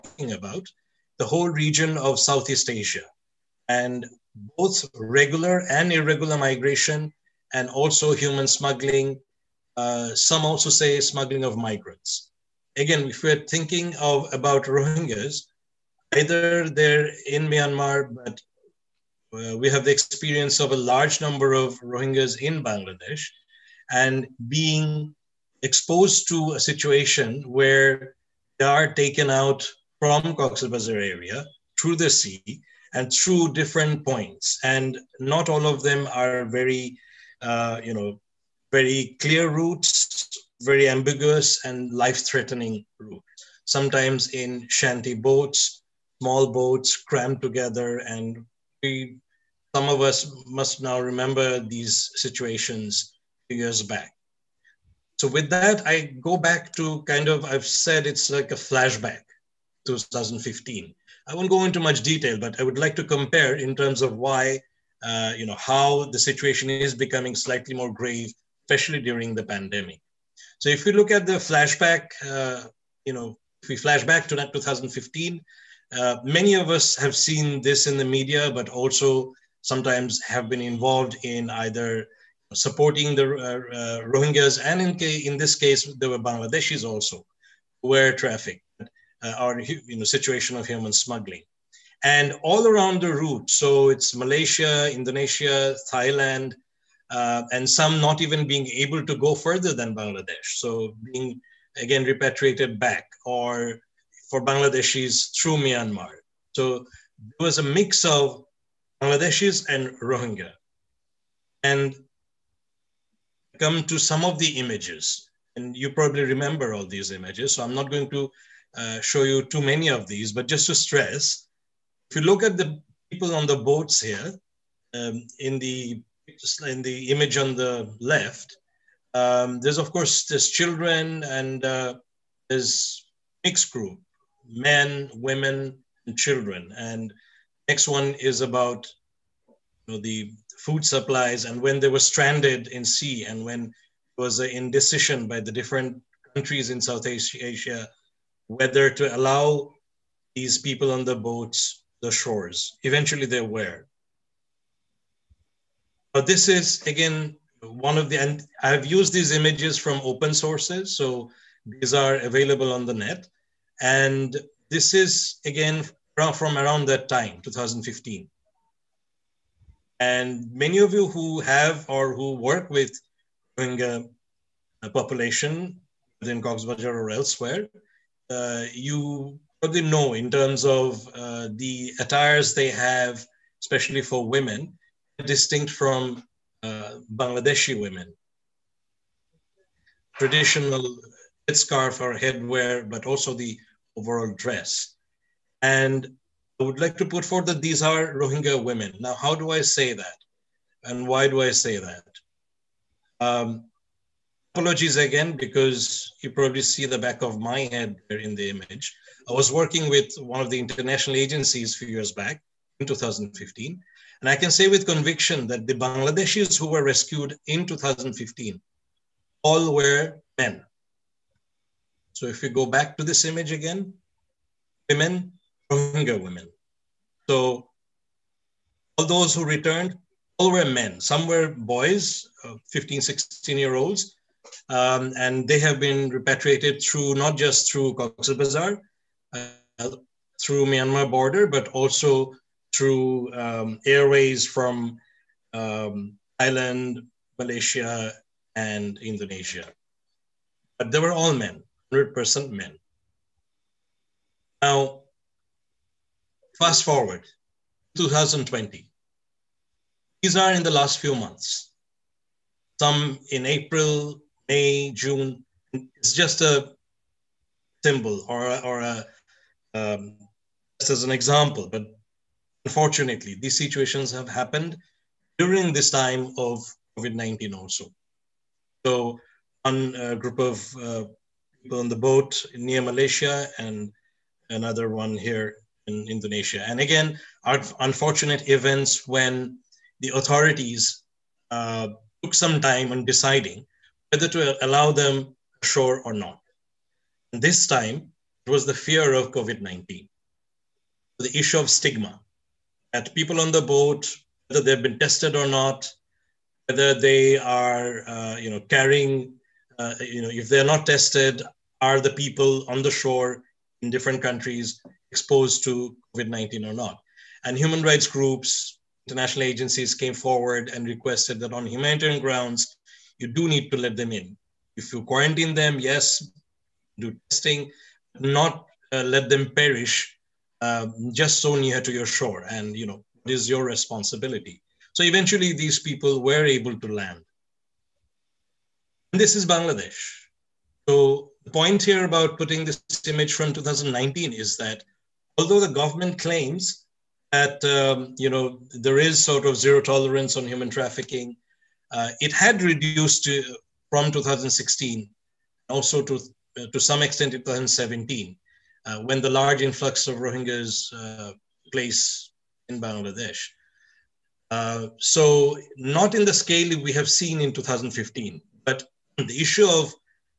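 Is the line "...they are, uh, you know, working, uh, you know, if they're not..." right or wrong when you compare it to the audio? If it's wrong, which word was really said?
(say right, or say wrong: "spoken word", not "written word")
wrong: "carrying", not "working".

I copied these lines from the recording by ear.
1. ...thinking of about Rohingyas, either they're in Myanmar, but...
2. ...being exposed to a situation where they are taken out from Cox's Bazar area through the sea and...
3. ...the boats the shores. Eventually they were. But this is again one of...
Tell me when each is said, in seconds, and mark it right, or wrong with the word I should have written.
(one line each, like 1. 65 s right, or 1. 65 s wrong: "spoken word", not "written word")
1. 13 s right
2. 24 s right
3. 151 s right.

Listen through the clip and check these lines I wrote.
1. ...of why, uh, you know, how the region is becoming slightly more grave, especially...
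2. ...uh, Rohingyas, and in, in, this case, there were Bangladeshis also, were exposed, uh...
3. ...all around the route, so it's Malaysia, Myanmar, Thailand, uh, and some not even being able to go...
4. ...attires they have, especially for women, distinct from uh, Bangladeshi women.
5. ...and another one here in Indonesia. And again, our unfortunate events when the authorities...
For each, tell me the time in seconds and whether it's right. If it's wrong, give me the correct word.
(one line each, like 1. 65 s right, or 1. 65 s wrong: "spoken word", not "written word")
1. 64 s wrong: "situation", not "region"
2. 83 s wrong: "trafficked", not "exposed"
3. 92 s wrong: "Indonesia", not "Myanmar"
4. 181 s right
5. 283 s right.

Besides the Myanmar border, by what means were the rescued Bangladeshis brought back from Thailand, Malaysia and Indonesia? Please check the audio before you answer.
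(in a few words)
Airways.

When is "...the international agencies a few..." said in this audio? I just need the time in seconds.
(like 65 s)
210 s.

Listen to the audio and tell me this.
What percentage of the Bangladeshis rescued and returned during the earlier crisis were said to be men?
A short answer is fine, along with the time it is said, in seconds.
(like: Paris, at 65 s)
100%, at 251 s.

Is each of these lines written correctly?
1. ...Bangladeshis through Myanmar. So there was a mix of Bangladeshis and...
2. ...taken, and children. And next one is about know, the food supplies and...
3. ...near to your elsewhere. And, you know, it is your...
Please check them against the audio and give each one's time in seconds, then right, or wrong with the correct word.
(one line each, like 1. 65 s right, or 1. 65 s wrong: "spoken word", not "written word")
1. 104 s right
2. 135 s wrong: "women", not "taken"
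3. 331 s wrong: "shore", not "elsewhere".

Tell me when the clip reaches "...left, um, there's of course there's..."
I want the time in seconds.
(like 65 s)
127 s.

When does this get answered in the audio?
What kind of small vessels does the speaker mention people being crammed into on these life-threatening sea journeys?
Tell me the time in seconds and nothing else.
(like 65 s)
44 s.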